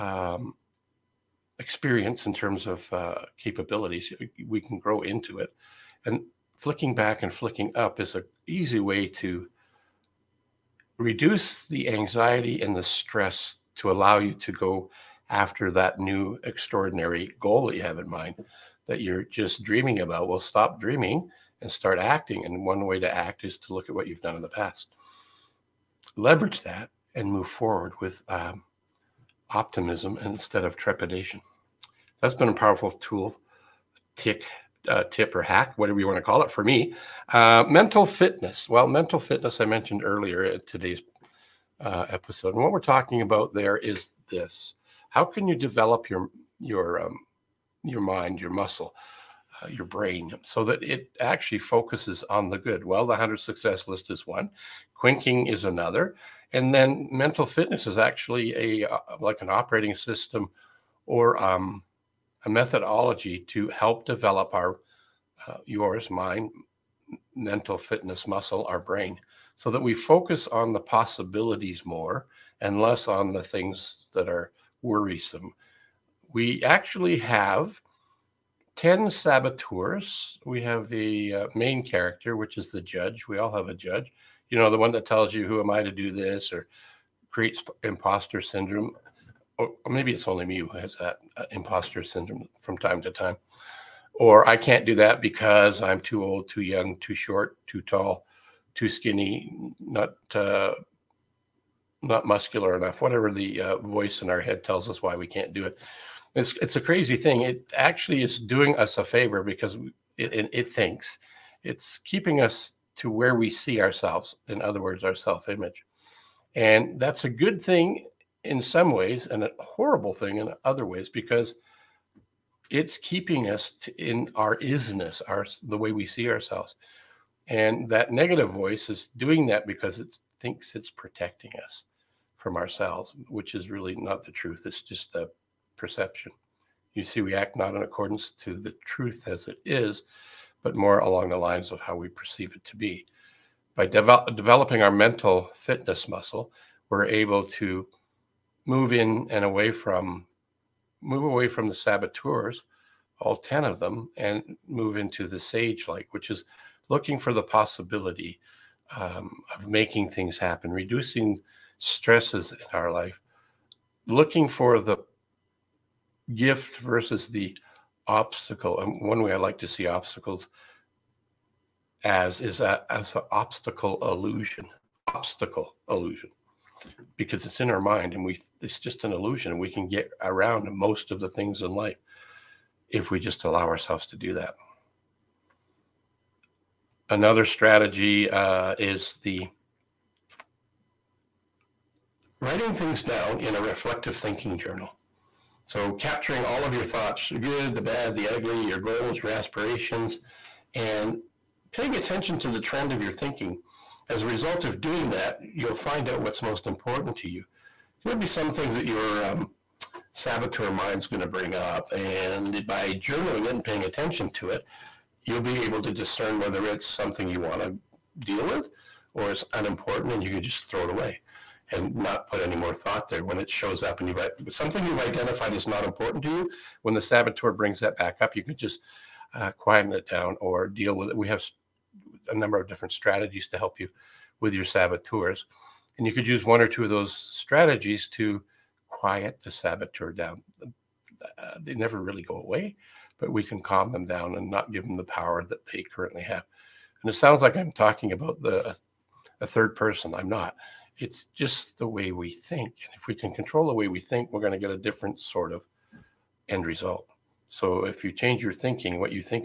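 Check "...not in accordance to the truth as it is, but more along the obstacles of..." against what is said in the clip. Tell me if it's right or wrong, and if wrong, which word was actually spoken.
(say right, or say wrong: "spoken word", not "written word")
wrong: "lines", not "obstacles".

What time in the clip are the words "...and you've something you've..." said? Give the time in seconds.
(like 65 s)
223 s.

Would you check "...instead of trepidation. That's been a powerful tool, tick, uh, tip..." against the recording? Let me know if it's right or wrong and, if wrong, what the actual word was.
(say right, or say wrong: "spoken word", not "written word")
right.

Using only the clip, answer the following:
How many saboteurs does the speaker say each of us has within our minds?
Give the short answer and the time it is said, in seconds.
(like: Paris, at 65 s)
10, at 78 s.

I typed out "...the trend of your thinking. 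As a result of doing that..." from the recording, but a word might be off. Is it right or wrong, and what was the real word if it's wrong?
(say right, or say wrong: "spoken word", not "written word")
right.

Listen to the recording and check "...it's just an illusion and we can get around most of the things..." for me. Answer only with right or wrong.
right.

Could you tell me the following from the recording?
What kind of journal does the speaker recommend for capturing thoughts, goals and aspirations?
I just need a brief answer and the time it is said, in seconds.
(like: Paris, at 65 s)
Reflective thinking journal, at 193 s.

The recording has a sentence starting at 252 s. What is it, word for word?
And if we can control the way we think, we're going to get a different sort of end result.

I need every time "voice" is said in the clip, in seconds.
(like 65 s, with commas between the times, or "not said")
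103 s, 128 s.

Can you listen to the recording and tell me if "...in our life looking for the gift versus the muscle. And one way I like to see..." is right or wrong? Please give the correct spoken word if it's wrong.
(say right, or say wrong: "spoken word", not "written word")
wrong: "obstacle", not "muscle".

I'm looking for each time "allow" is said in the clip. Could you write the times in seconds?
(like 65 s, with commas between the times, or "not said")
13 s, 183 s.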